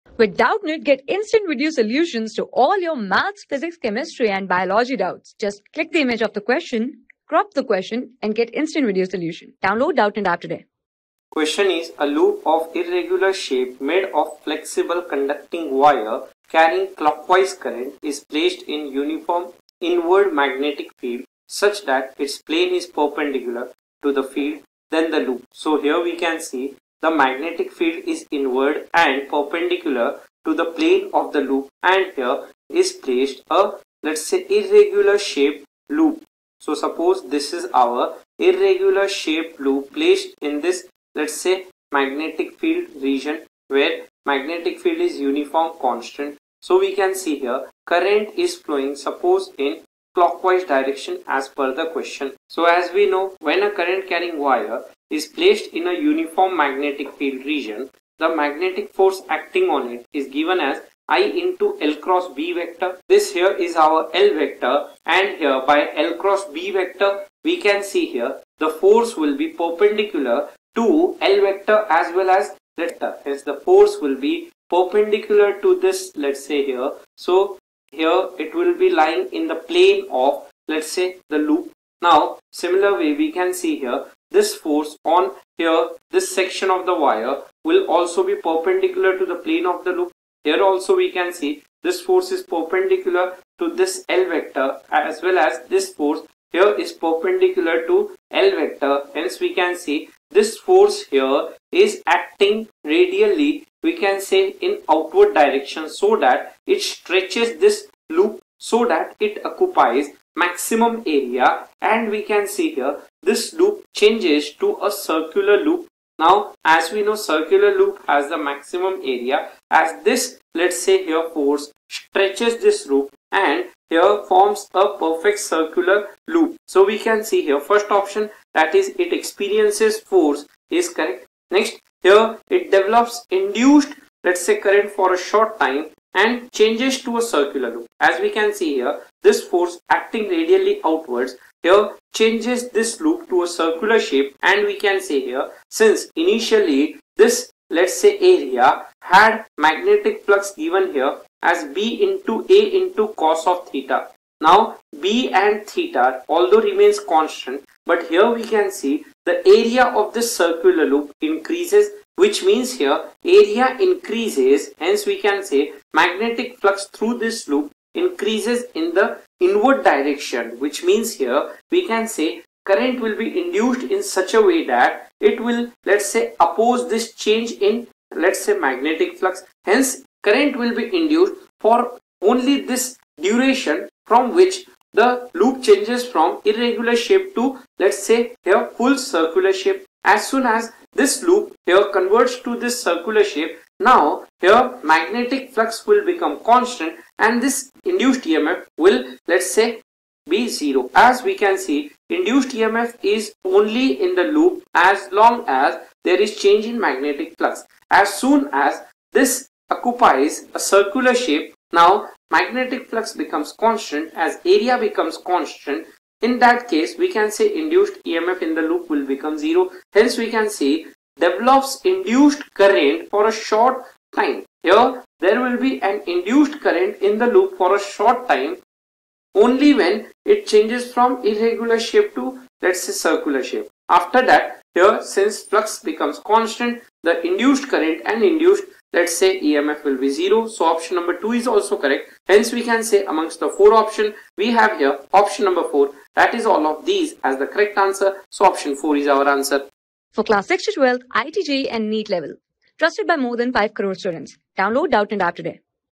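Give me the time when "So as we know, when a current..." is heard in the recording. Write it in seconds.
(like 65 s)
52 s.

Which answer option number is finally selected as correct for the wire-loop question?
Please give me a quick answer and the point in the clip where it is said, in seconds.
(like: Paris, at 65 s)
4, at 248 s.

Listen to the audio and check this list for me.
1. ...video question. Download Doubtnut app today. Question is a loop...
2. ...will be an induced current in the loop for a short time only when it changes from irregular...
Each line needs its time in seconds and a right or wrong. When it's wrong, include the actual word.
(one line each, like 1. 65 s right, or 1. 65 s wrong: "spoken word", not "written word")
1. 8 s wrong: "solution", not "question"
2. 225 s right.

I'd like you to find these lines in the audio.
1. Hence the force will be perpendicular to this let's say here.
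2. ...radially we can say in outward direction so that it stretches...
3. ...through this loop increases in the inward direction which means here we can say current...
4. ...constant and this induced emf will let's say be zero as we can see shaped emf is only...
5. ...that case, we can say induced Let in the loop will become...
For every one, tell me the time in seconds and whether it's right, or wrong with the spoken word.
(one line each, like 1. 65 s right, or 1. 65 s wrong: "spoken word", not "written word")
1. 73 s right
2. 102 s right
3. 166 s right
4. 196 s wrong: "induced", not "shaped"
5. 216 s wrong: "EMF", not "Let".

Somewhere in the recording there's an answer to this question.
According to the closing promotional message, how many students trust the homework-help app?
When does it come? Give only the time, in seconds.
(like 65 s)
253 s.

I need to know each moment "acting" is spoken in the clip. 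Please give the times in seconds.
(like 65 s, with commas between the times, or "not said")
59 s, 102 s, 139 s.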